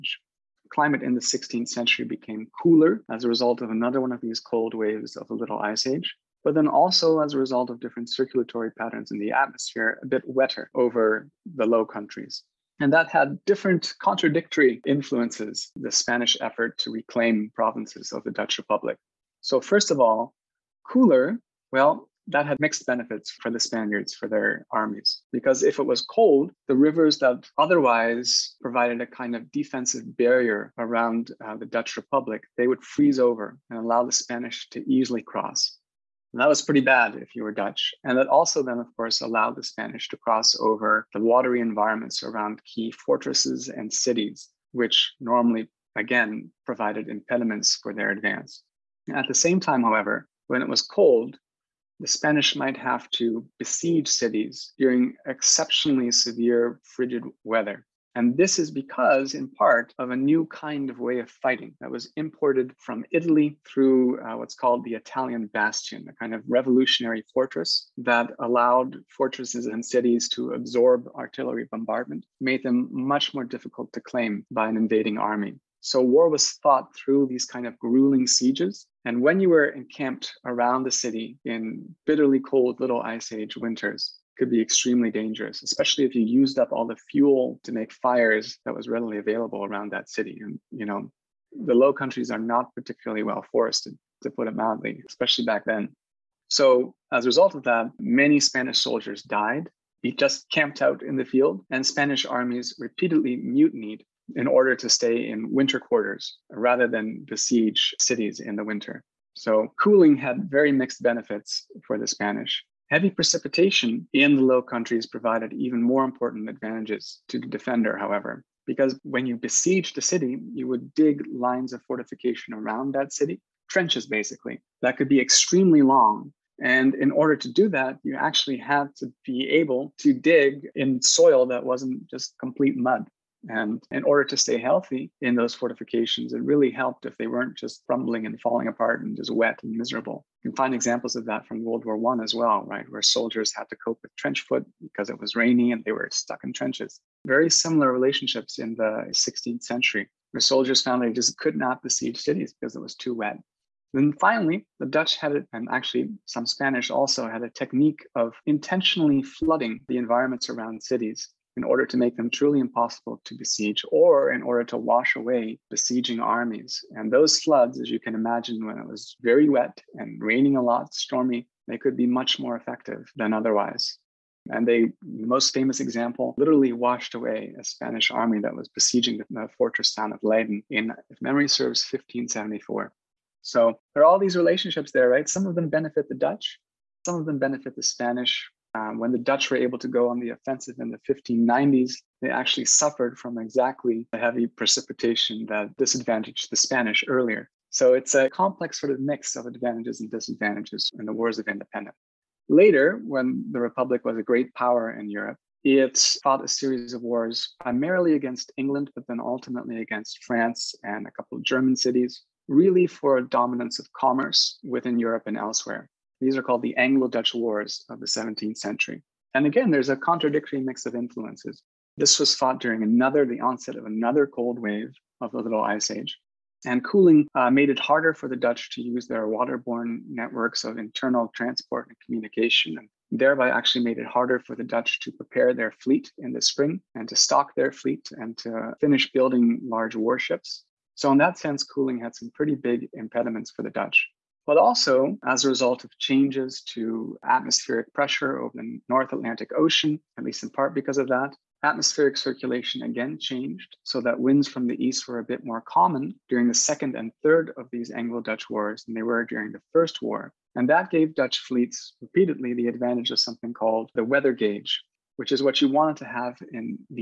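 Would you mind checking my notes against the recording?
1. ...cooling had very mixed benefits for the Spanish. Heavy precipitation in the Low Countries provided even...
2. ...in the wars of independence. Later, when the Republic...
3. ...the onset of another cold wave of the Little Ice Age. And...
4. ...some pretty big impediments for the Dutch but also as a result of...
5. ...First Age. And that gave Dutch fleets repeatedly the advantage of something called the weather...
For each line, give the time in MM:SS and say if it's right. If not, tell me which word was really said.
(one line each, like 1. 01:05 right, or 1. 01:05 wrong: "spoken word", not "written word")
1. 01:49 right
2. 03:20 right
3. 03:43 right
4. 04:02 right
5. 04:19 wrong: "War", not "Age".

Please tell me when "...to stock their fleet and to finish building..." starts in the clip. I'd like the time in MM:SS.
03:57.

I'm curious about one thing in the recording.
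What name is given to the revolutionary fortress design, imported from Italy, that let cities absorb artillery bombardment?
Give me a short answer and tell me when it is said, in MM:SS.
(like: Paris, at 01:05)
Italian bastion, at 01:04.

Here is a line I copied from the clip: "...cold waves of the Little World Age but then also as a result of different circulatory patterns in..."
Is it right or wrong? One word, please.
wrong.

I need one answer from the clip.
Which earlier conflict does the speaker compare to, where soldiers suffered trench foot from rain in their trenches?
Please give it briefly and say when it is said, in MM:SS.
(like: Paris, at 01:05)
World War One, at 02:21.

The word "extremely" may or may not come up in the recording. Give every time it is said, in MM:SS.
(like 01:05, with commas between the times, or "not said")
01:24, 02:05.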